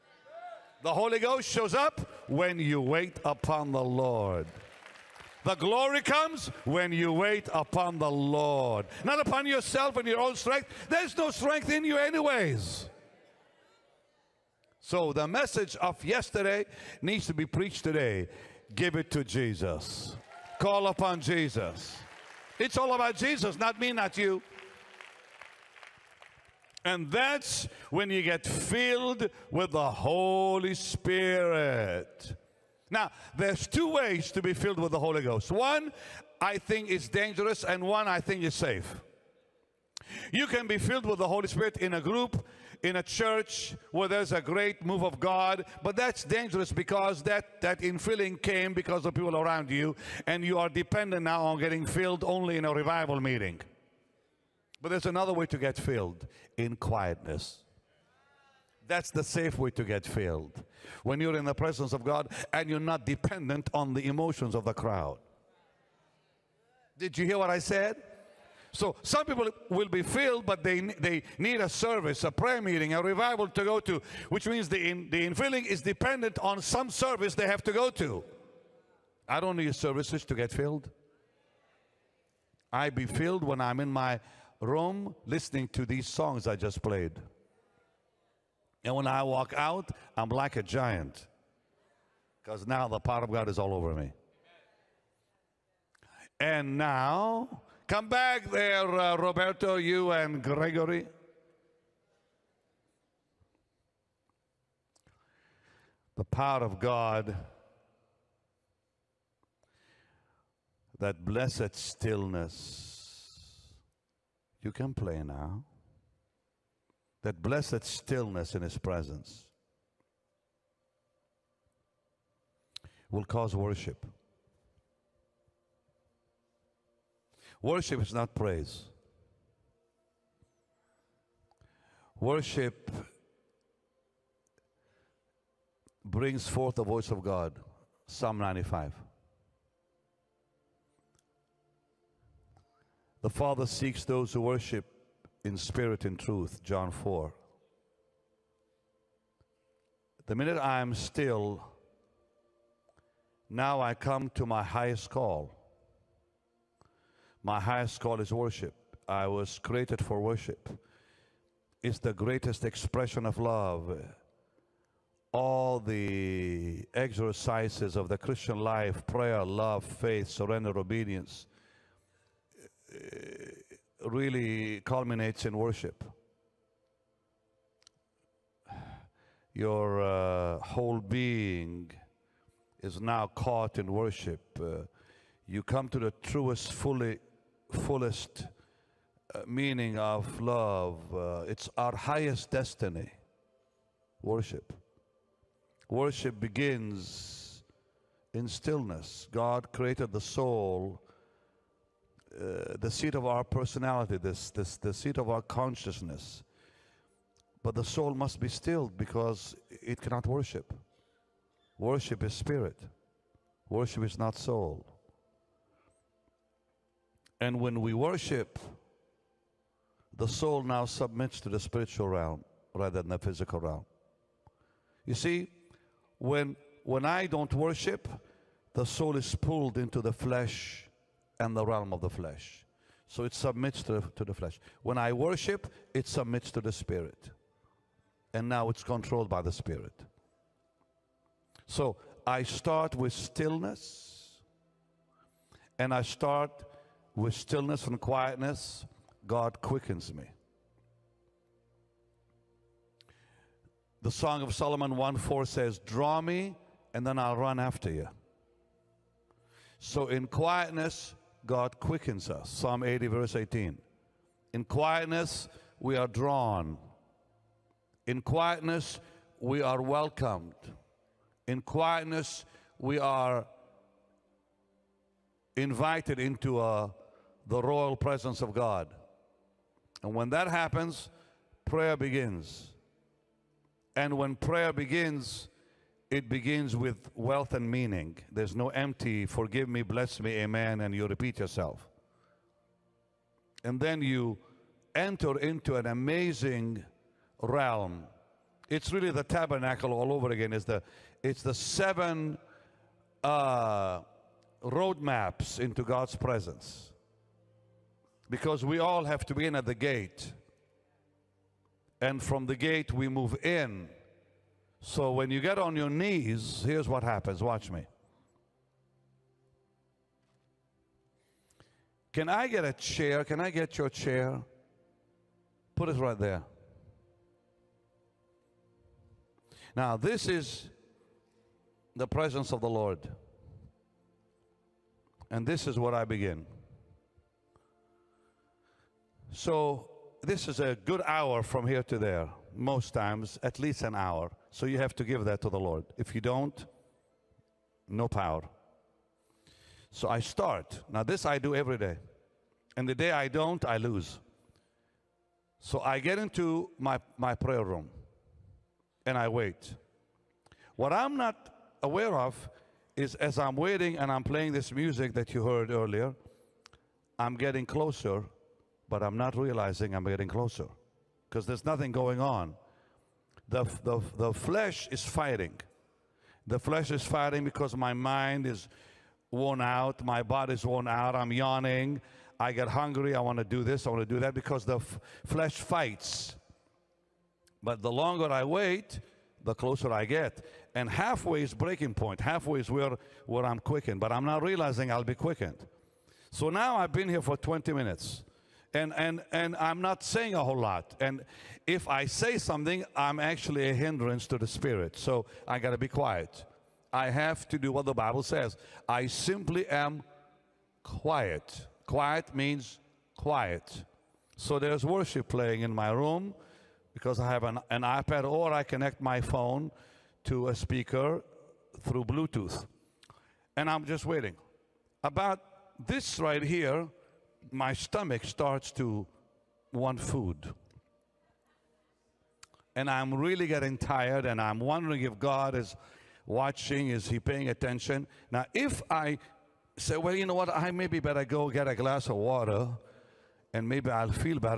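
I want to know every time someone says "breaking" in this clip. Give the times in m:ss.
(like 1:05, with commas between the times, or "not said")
6:31.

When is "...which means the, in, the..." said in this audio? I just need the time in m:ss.
1:14.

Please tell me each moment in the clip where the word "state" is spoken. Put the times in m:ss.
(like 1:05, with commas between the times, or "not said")
not said.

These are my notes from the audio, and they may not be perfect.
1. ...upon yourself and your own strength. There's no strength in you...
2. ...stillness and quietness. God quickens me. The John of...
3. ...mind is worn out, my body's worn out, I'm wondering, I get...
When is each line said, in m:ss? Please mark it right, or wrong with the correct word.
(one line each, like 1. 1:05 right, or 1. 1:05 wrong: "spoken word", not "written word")
1. 0:09 right
2. 4:07 wrong: "Song", not "John"
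3. 6:17 wrong: "yawning", not "wondering".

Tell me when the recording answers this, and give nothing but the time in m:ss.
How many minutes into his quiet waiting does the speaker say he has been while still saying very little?
6:37.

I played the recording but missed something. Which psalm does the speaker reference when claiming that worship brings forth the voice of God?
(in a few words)
Psalm 95.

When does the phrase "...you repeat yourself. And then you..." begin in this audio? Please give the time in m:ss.
4:50.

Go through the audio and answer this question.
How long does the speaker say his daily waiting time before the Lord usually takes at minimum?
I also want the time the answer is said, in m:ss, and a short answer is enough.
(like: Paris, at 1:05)
1 hour, at 5:43.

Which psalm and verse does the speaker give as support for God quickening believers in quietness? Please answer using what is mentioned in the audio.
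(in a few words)
Psalm 80:18.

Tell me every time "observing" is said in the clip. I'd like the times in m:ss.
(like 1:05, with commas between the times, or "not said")
not said.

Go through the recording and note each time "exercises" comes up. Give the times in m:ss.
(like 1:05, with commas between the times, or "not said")
2:46.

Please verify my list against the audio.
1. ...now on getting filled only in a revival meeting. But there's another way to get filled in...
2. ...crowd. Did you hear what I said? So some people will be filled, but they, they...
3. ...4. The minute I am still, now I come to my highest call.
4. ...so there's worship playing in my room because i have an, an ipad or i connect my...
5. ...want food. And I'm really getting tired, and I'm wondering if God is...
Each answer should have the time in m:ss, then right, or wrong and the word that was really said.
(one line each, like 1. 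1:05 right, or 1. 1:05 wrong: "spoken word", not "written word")
1. 0:51 right
2. 1:04 right
3. 2:26 right
4. 6:54 right
5. 7:09 right.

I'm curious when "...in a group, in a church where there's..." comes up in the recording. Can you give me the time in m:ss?
0:41.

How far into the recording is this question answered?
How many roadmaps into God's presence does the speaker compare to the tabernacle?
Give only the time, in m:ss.
5:01.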